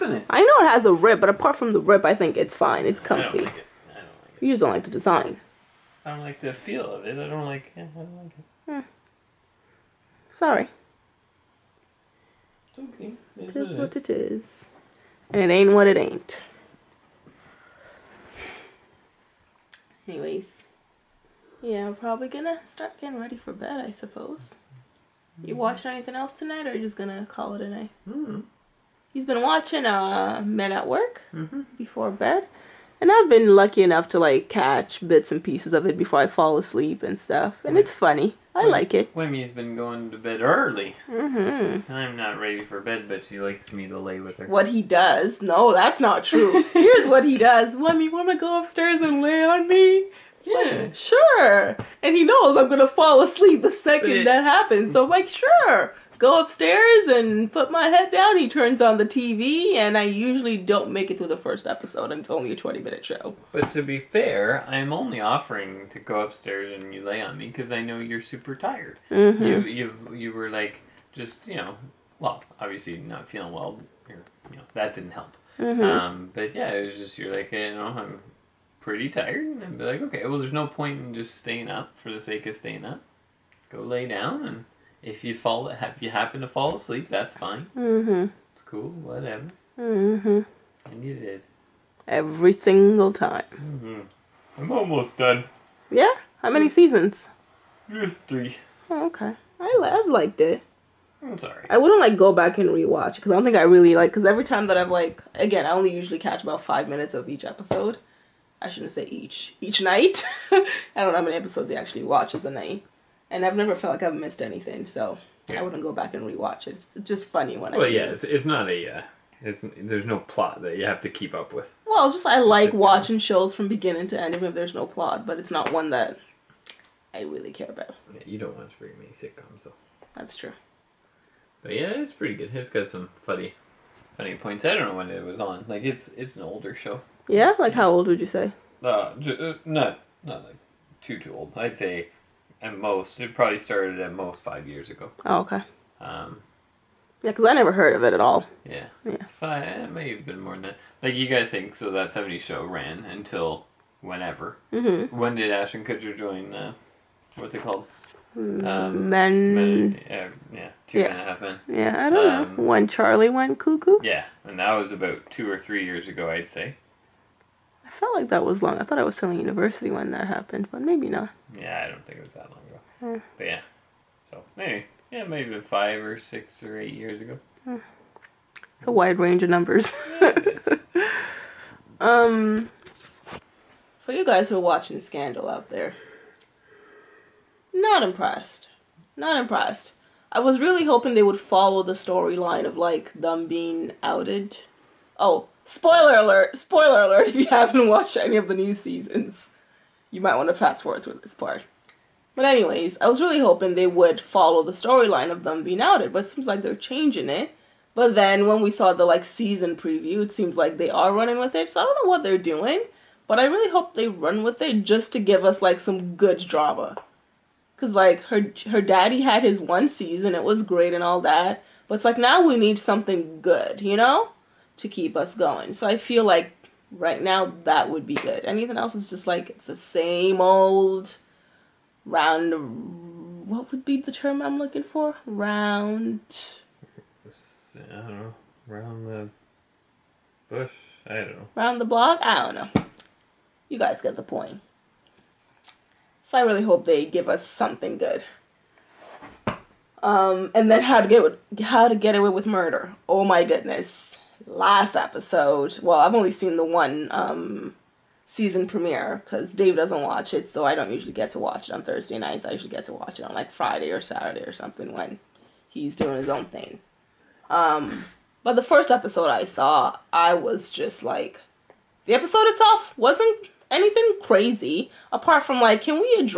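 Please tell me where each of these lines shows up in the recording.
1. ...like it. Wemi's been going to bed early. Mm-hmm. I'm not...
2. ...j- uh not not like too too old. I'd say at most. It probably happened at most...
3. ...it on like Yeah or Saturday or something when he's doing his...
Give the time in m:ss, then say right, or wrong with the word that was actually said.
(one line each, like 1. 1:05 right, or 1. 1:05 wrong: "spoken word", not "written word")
1. 0:38 right
2. 2:19 wrong: "started", not "happened"
3. 4:23 wrong: "Friday", not "Yeah".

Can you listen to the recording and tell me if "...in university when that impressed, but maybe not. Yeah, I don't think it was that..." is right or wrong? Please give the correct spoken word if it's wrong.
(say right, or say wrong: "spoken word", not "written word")
wrong: "happened", not "impressed".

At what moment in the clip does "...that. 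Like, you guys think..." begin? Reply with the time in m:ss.
2:30.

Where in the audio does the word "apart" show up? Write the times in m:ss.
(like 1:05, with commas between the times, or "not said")
0:01, 4:35.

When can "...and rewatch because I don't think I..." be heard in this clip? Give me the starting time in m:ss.
1:42.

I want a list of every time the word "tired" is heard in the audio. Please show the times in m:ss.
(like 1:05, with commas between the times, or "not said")
1:08, 1:19.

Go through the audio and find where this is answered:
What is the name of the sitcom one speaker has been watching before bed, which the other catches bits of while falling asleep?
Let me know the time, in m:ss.
0:30.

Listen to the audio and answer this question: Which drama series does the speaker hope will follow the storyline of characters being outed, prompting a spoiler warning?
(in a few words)
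Scandal.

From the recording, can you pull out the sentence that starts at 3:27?
But then when we saw the like season preview, it seems like they are running with it.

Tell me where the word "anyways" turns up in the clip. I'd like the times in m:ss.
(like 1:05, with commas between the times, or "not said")
0:20, 3:22.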